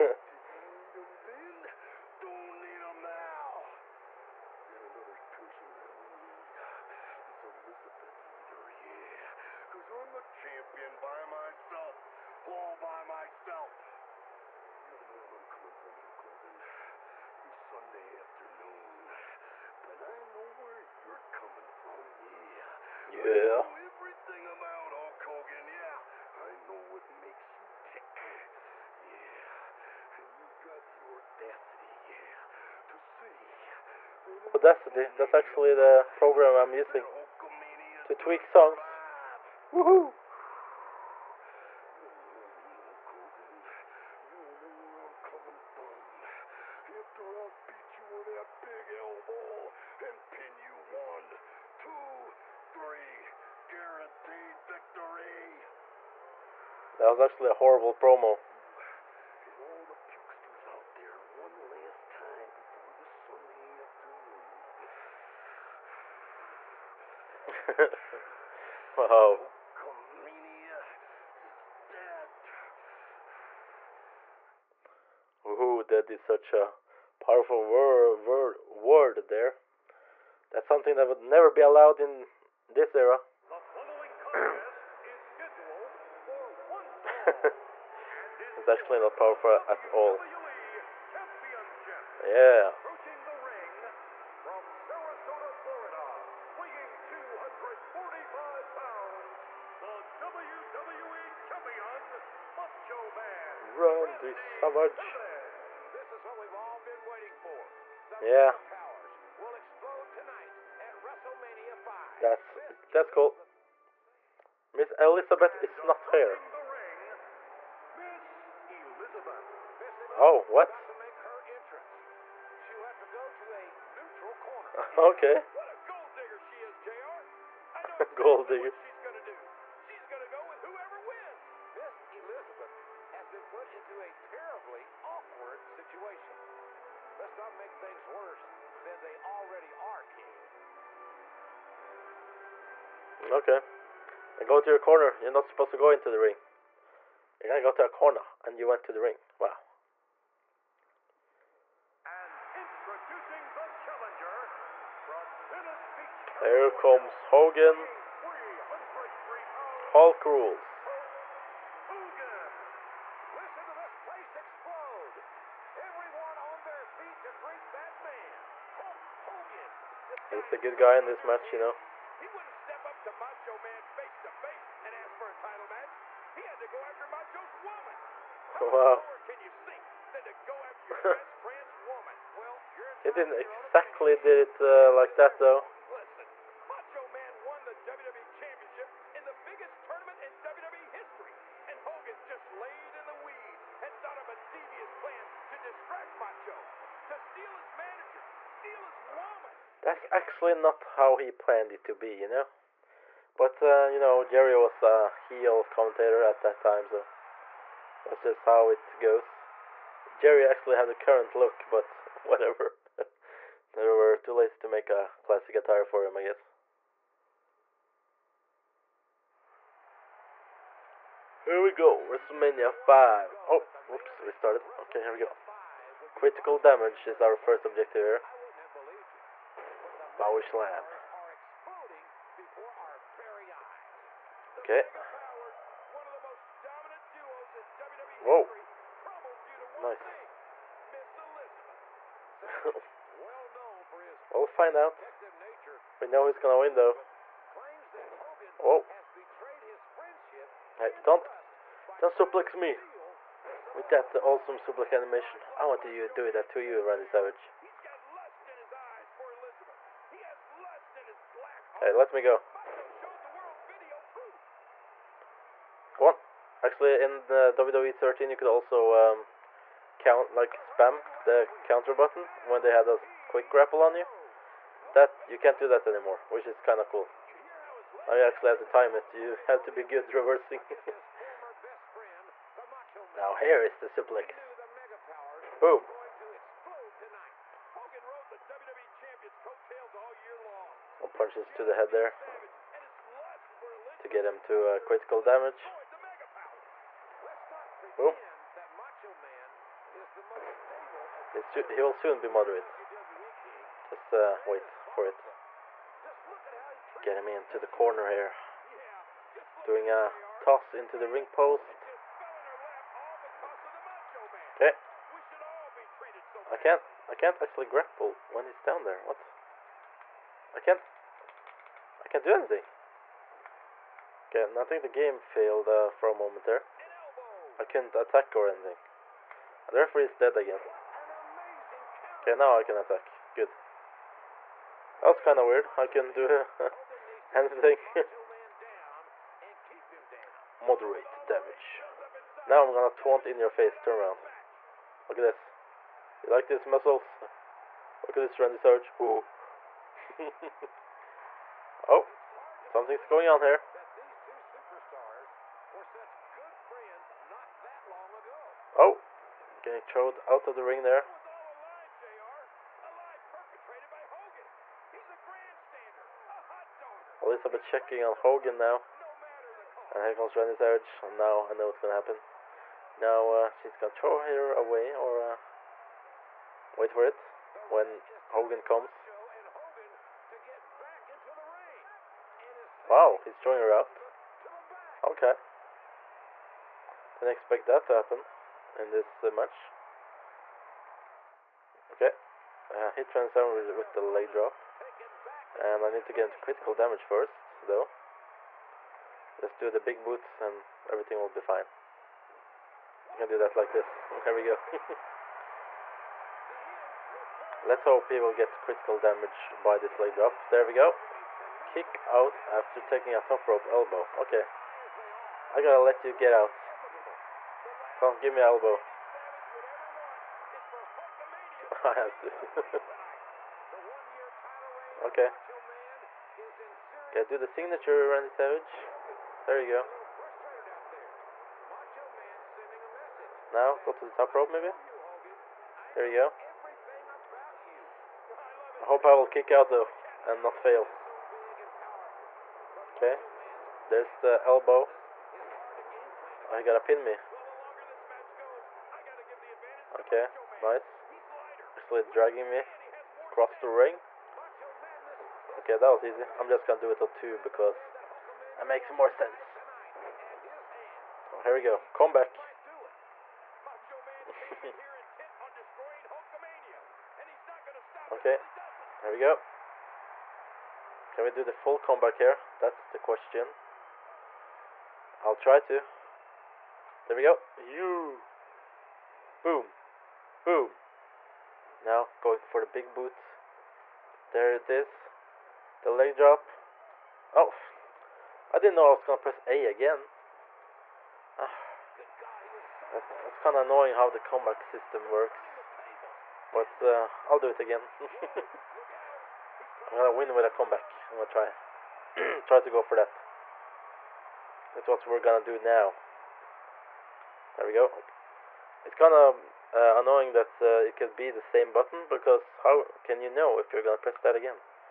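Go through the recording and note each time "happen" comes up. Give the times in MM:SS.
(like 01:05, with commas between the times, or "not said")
06:11, 06:27.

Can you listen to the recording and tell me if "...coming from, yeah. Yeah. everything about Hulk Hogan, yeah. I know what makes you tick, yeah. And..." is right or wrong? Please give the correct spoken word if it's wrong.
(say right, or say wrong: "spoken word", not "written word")
right.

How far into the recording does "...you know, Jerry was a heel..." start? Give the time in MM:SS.
03:23.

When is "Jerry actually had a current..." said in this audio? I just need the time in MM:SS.
03:30.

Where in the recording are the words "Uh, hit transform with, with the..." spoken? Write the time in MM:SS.
06:32.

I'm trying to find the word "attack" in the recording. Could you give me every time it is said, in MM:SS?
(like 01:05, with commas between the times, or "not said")
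05:27, 05:32.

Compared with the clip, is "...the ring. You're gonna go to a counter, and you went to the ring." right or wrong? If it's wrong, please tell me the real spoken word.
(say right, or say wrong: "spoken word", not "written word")
wrong: "corner", not "counter".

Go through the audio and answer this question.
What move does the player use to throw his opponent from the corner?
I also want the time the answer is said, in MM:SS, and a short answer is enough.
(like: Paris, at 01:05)
toss into the ring post, at 05:10.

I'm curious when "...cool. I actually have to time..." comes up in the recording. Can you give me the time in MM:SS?
04:36.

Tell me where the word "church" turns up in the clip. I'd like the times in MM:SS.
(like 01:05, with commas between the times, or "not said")
not said.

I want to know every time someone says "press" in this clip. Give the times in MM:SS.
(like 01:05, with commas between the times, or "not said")
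08:09, 08:33.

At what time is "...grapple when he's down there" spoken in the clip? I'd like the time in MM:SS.
05:17.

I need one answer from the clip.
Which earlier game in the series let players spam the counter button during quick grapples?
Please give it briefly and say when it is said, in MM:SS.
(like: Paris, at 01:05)
WWE 13, at 04:27.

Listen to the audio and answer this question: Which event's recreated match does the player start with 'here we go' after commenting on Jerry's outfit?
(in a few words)
WrestleMania 5.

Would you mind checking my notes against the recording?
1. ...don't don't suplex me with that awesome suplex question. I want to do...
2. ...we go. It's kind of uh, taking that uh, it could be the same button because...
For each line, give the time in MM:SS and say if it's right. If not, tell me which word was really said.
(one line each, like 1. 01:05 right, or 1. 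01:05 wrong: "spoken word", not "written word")
1. 04:11 wrong: "animation", not "question"
2. 08:27 wrong: "annoying", not "taking".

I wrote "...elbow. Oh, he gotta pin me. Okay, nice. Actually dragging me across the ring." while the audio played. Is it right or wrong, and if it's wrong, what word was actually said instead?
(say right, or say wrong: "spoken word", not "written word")
right.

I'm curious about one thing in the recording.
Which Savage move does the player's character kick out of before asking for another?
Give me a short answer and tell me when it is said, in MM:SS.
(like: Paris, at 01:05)
top rope elbow, at 06:53.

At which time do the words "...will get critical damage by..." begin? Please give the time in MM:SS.
06:48.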